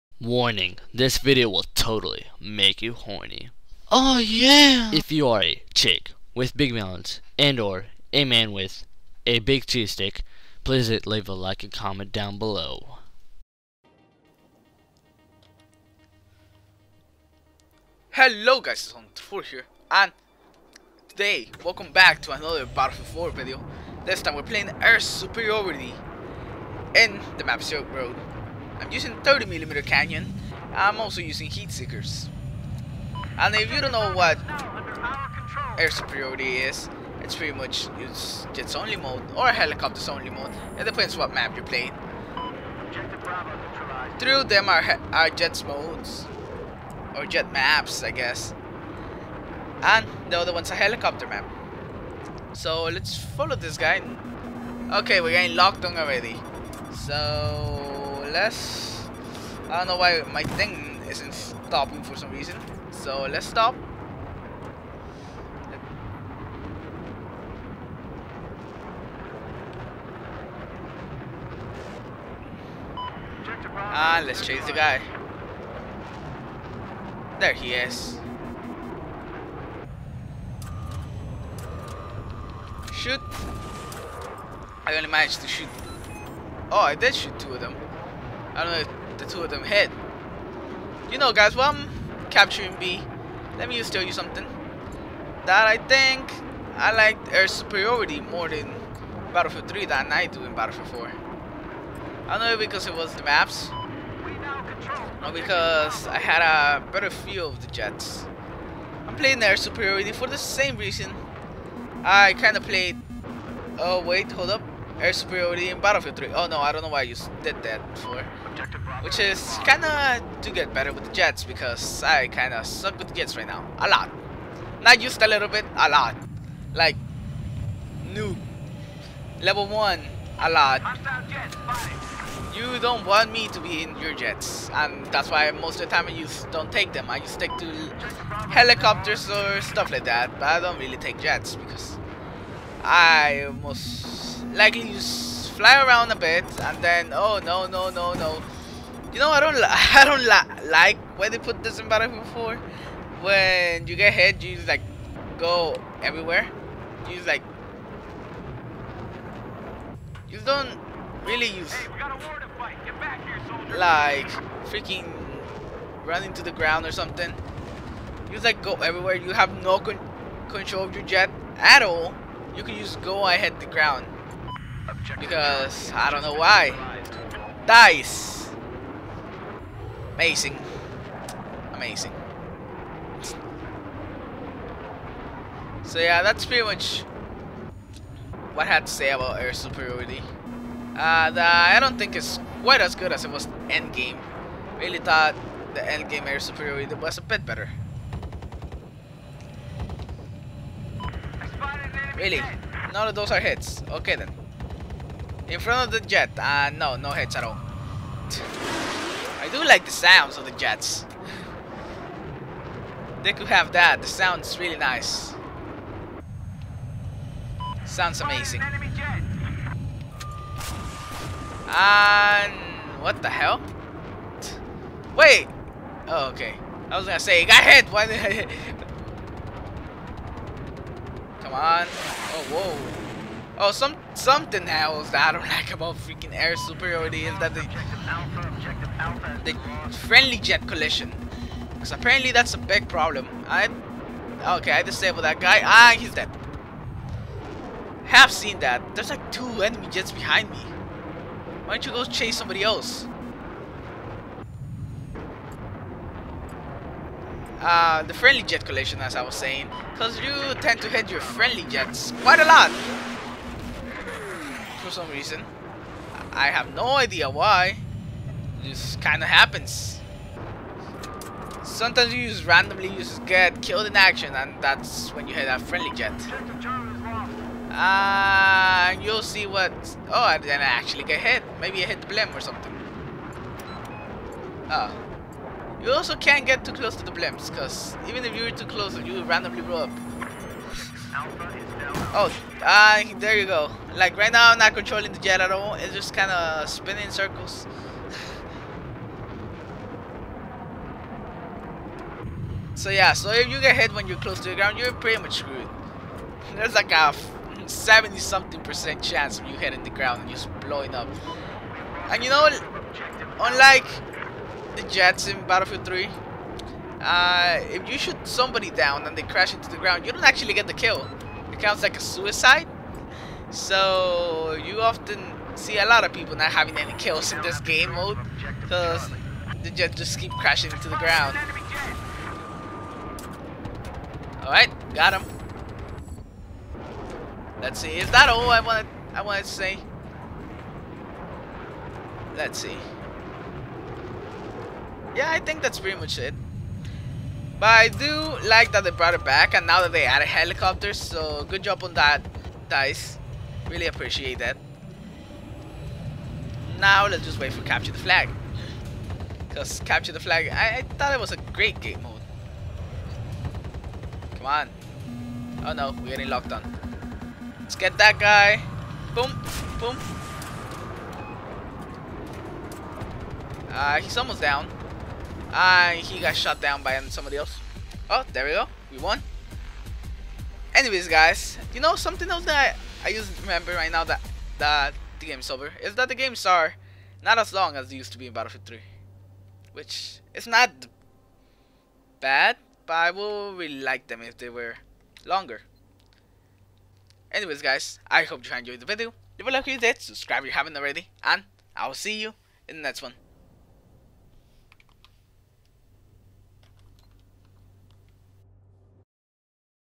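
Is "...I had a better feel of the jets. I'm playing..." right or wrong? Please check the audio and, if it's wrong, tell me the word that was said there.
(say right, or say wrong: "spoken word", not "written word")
right.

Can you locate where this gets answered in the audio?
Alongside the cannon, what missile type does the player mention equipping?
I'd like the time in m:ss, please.
0:31.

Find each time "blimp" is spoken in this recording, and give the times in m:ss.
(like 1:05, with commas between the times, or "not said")
4:42, 4:47.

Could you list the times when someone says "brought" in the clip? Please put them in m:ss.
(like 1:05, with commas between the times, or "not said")
5:48.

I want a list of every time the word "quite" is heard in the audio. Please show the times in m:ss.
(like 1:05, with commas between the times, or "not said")
3:12, 4:22.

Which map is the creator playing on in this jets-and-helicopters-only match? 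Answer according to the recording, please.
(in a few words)
Silk Road.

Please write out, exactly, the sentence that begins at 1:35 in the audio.
That I think I like air superiority more than Battlefield 3 than I do in Battlefield 4.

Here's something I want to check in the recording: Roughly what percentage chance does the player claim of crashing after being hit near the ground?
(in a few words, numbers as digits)
70 something percent.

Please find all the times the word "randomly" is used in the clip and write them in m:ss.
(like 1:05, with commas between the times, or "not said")
4:32, 4:49.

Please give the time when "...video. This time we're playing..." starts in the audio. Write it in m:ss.
0:23.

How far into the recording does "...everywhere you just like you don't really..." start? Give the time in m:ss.
2:36.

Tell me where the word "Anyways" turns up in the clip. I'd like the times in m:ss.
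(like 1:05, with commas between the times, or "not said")
6:20, 6:37.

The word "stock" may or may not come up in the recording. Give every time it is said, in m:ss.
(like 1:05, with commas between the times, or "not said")
not said.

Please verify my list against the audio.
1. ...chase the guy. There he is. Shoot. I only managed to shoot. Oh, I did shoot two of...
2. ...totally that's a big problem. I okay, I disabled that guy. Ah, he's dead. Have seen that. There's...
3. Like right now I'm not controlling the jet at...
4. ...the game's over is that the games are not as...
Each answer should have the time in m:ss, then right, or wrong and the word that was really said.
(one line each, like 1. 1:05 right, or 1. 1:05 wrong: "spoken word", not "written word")
1. 1:14 right
2. 4:01 wrong: "apparently", not "totally"
3. 4:53 right
4. 6:25 right.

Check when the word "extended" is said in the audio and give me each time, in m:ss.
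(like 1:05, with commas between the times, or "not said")
not said.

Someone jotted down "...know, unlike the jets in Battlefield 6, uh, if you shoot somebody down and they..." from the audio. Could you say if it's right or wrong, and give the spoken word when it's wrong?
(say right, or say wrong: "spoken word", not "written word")
wrong: "3", not "6".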